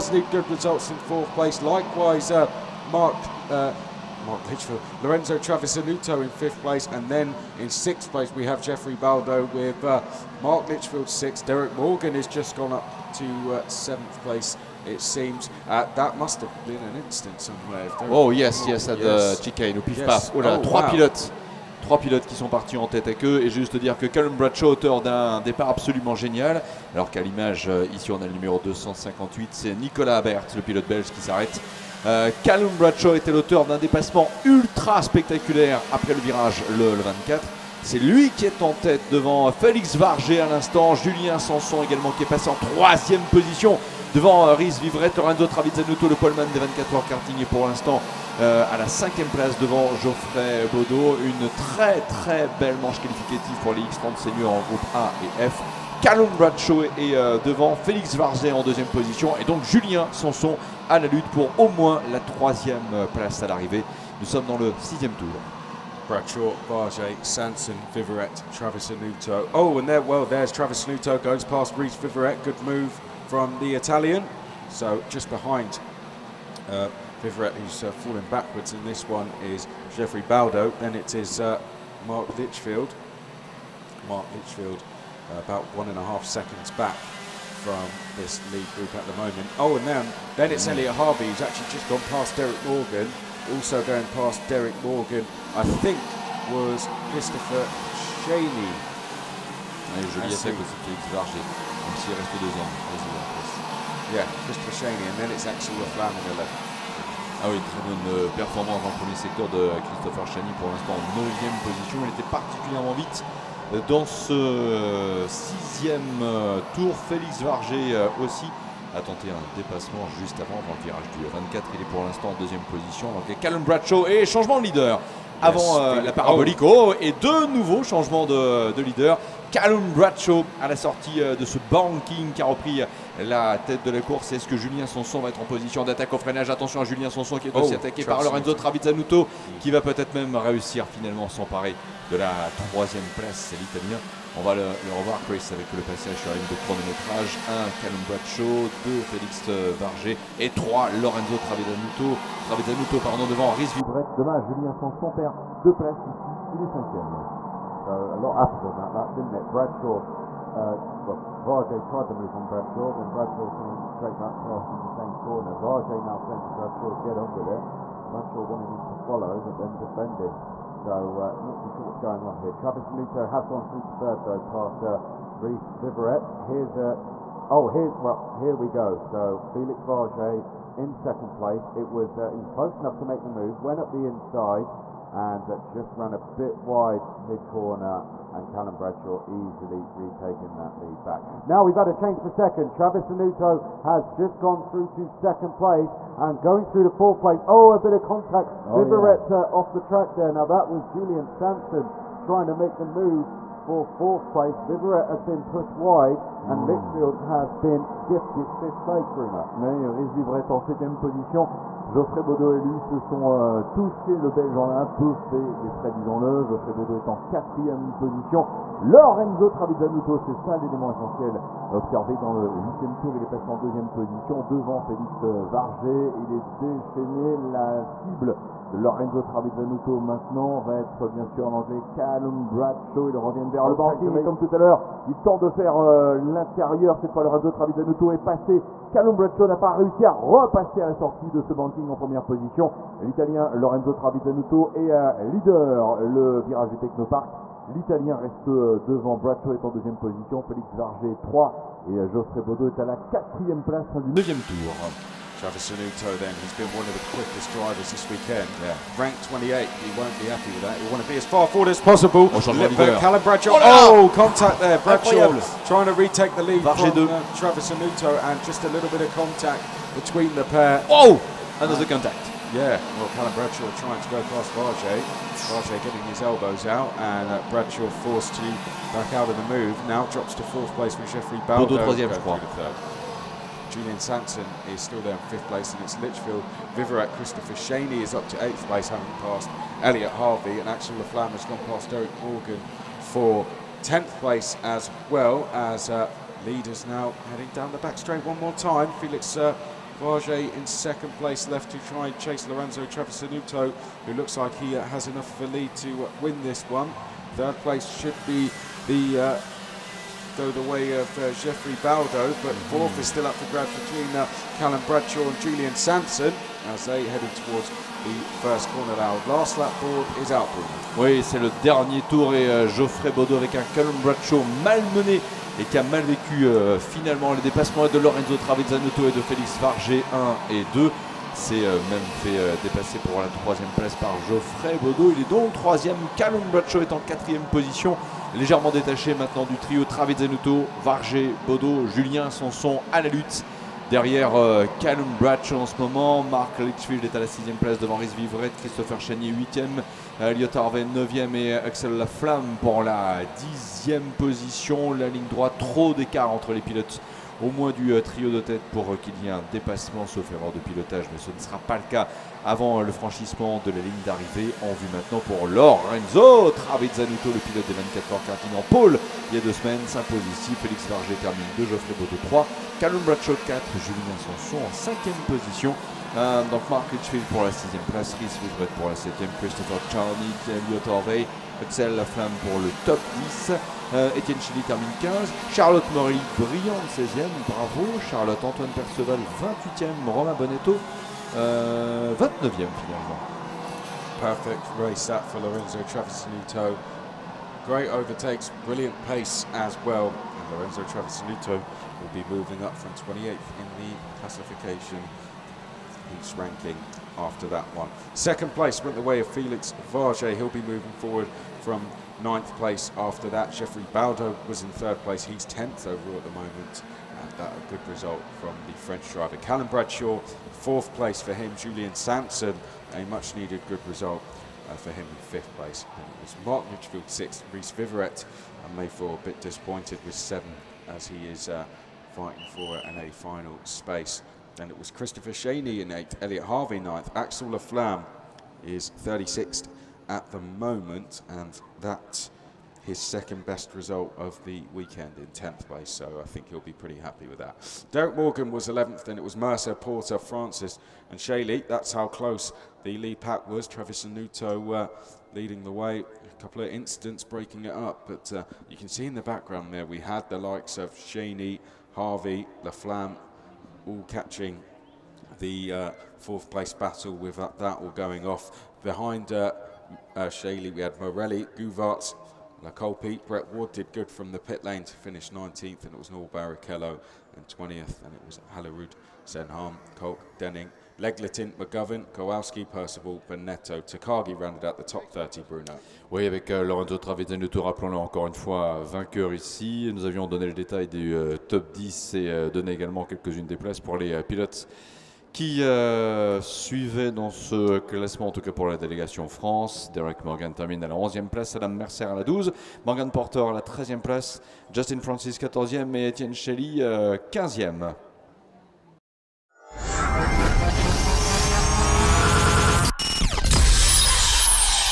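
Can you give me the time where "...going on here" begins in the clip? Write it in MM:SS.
02:51.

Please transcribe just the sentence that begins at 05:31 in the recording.
C'est euh, même fait euh, dépasser pour la troisième place par Geoffrey Bodo.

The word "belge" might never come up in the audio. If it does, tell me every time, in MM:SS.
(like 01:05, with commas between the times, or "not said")
00:30, 03:34.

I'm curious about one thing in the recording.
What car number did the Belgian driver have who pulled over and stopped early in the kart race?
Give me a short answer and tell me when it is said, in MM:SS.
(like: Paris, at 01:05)
258, at 00:28.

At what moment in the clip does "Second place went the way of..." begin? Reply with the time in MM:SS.
06:48.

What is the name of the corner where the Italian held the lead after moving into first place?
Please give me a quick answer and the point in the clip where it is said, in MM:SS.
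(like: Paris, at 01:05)
Technopark, at 04:06.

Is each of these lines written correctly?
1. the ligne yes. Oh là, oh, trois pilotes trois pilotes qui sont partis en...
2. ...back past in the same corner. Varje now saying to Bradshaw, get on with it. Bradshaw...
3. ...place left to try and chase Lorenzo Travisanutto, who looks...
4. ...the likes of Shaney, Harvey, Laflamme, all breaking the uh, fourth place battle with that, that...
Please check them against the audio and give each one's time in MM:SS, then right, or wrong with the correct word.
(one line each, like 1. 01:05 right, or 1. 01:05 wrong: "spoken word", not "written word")
1. 00:19 wrong: "chicane", not "ligne"
2. 02:44 right
3. 05:01 right
4. 07:40 wrong: "catching", not "breaking".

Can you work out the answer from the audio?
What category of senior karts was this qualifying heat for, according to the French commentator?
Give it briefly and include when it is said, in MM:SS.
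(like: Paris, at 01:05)
X30, at 00:53.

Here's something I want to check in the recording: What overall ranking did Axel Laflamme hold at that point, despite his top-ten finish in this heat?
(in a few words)
36th.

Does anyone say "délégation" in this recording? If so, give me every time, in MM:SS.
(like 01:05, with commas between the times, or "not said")
08:18.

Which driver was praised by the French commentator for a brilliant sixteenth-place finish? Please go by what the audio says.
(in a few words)
Charlotte Morelli.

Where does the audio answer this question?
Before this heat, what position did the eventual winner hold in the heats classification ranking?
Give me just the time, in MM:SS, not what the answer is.
04:18.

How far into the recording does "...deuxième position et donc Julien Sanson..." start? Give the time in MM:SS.
00:58.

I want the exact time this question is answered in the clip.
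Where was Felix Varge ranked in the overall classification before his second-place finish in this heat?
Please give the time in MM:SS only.
06:52.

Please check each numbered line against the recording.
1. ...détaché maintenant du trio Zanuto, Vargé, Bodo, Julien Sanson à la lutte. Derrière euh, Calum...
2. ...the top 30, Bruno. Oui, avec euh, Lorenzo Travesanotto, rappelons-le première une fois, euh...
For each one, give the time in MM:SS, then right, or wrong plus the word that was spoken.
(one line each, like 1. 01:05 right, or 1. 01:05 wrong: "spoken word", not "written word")
1. 05:38 right
2. 08:04 wrong: "encore", not "première".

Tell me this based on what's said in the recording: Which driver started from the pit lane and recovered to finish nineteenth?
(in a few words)
Brett Ward.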